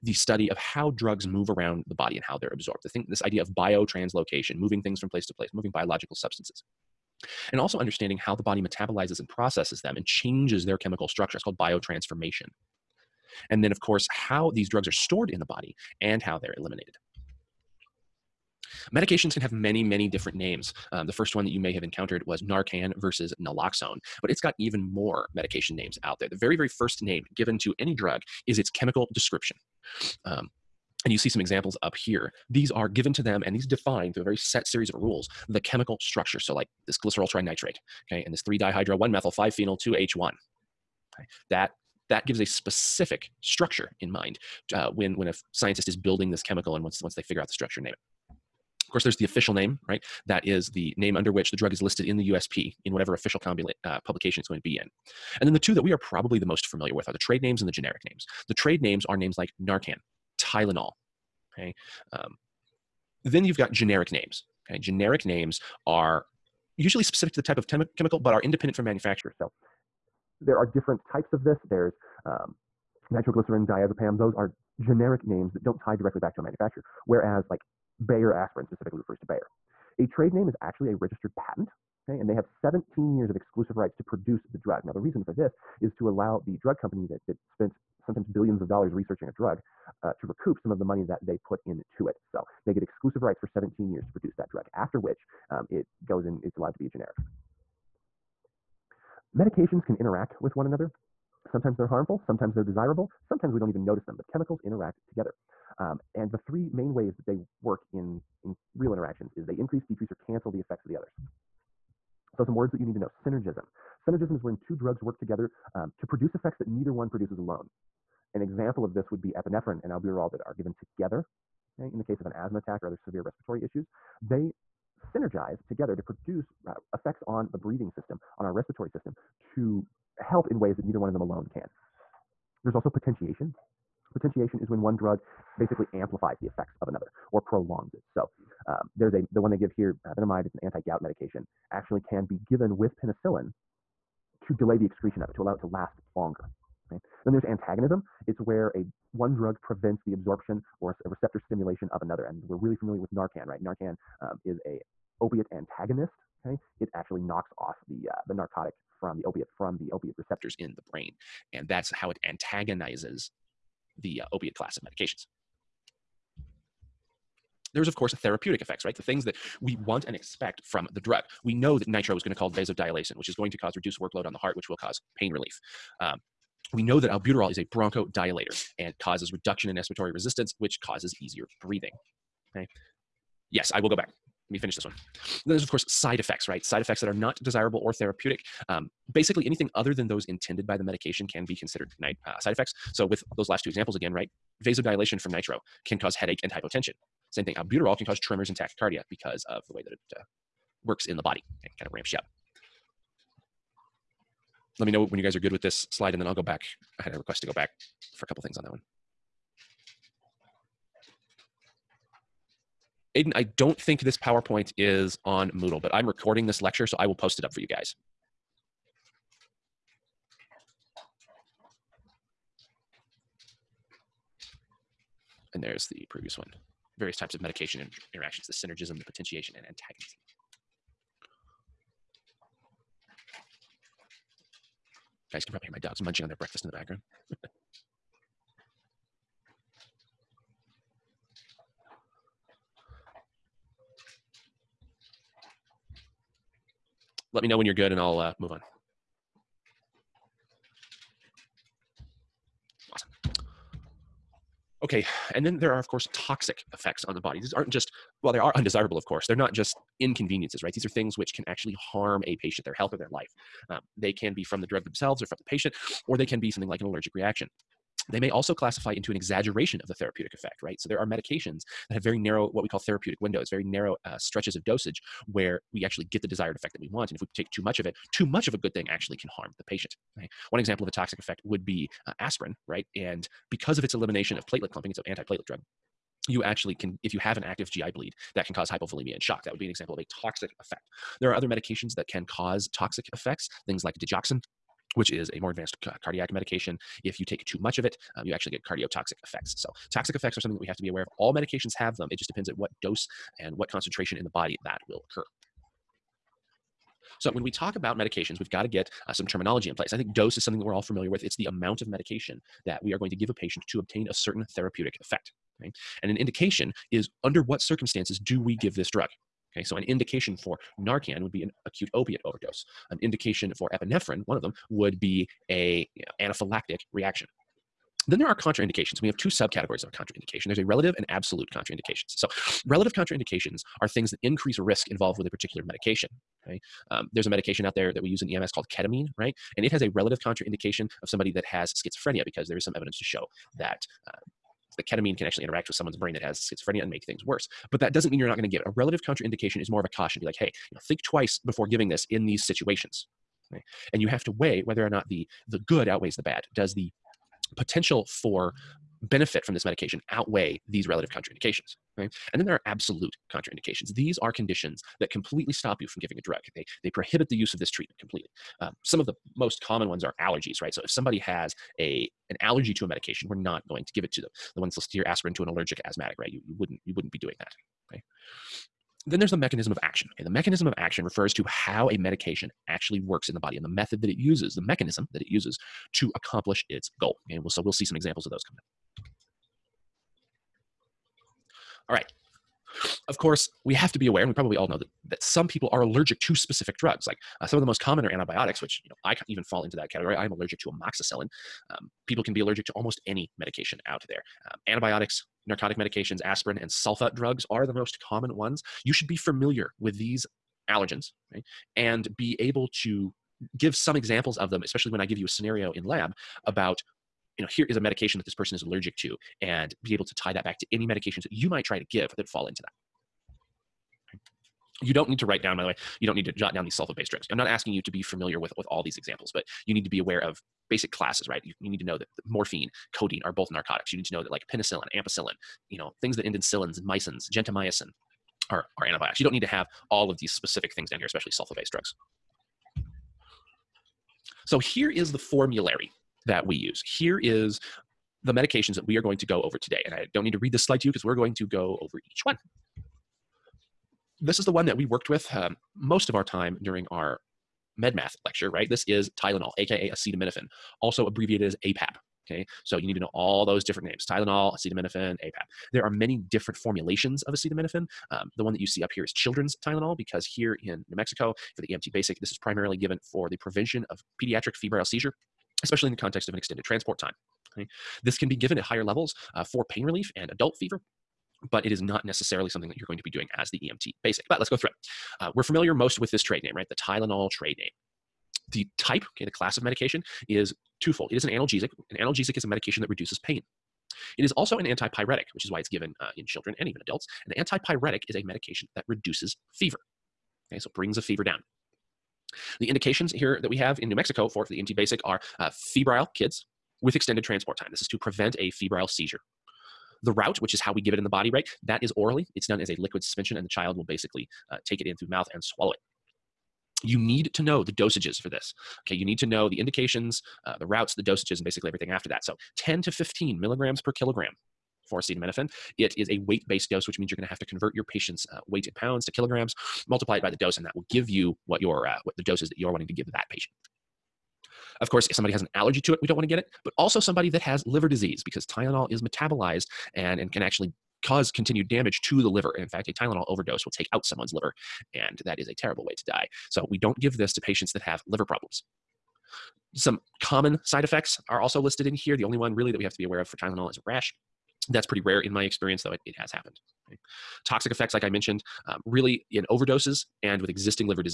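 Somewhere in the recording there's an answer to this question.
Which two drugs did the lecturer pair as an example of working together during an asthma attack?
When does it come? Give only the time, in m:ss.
1:59.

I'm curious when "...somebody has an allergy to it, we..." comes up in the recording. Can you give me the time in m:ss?
8:55.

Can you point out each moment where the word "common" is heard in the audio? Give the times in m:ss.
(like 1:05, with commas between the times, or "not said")
6:09, 6:37, 6:48, 9:10.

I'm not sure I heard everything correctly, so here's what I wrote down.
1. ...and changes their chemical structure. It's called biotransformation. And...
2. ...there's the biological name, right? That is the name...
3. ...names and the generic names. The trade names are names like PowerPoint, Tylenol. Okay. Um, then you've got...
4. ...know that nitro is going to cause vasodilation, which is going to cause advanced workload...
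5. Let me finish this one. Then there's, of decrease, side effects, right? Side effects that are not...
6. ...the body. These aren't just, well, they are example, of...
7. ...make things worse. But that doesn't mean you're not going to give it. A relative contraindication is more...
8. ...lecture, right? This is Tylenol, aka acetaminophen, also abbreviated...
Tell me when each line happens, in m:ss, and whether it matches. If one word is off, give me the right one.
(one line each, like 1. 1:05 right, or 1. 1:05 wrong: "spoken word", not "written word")
1. 0:09 right
2. 0:49 wrong: "official", not "biological"
3. 0:57 wrong: "Narcan", not "PowerPoint"
4. 2:51 wrong: "reduced", not "advanced"
5. 3:04 wrong: "course", not "decrease"
6. 4:17 wrong: "undesirable", not "example"
7. 5:46 right
8. 7:38 right.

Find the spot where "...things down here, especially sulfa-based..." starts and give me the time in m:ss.
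7:20.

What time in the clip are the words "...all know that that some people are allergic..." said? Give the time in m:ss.
6:34.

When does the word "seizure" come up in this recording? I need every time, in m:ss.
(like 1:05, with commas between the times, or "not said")
7:54, 8:28.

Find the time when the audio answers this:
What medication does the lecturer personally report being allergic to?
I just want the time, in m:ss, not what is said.
6:40.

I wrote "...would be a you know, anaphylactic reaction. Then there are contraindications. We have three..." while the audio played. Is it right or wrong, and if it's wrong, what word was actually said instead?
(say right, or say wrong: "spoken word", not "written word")
wrong: "two", not "three".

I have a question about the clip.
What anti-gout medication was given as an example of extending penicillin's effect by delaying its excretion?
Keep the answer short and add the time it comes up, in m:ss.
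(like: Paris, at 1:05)
Benemid, at 2:20.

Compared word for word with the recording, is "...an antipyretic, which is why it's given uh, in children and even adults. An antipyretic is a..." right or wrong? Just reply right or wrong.
right.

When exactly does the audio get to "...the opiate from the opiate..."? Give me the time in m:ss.
2:39.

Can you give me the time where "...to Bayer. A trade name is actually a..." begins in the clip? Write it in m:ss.
1:19.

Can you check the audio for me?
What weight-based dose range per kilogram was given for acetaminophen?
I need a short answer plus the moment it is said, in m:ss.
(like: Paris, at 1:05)
10 to 15 mg/kg, at 8:42.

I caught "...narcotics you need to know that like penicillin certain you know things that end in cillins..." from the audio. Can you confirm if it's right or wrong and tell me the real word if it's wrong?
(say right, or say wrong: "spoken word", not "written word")
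wrong: "ampicillin", not "certain".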